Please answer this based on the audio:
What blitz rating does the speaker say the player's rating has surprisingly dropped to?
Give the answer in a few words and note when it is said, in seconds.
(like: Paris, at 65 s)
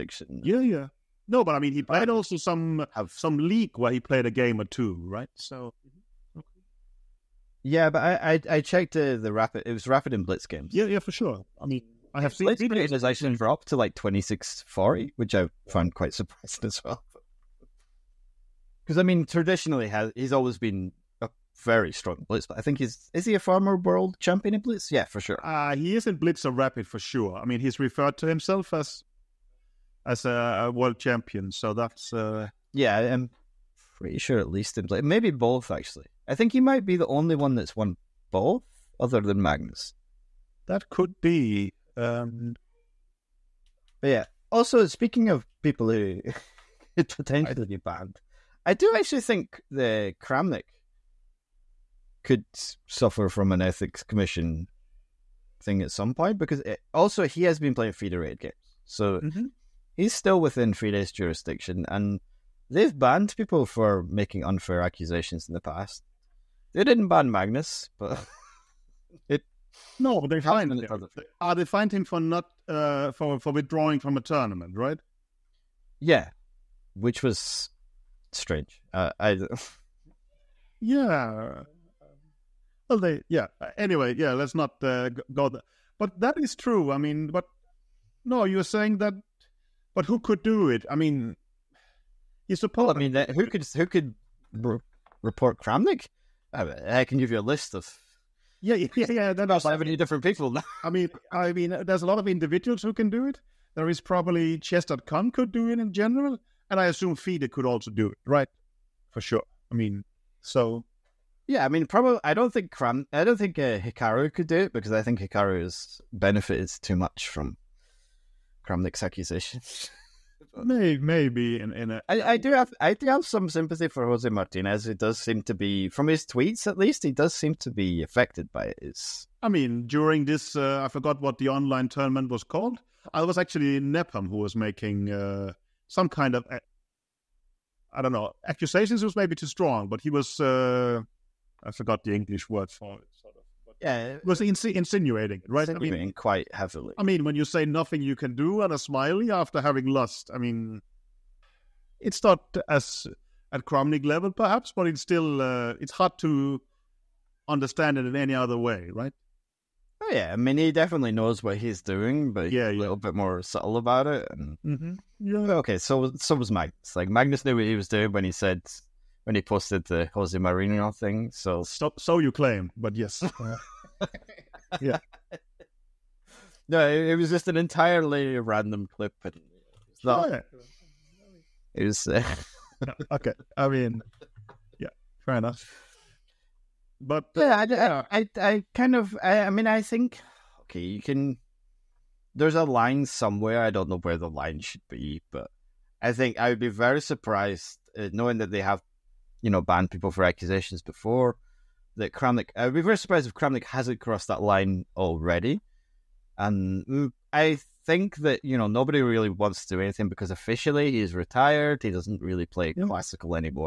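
2640, at 13 s.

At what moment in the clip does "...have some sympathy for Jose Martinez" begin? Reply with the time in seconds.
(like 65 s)
123 s.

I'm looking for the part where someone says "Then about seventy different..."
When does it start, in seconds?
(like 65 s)
99 s.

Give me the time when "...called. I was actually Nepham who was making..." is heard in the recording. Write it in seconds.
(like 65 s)
132 s.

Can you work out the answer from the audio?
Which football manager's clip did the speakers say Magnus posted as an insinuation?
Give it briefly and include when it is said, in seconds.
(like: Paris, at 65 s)
Jose Mourinho, at 170 s.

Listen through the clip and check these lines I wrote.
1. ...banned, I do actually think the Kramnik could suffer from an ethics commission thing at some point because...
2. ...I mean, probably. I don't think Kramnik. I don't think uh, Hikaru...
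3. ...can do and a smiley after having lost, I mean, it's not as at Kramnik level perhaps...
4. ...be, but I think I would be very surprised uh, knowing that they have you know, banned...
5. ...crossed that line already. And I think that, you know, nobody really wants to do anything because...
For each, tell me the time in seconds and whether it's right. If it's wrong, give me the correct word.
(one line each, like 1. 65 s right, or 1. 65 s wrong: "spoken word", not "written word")
1. 47 s right
2. 111 s wrong: "Cram", not "Kramnik"
3. 148 s right
4. 194 s right
5. 204 s right.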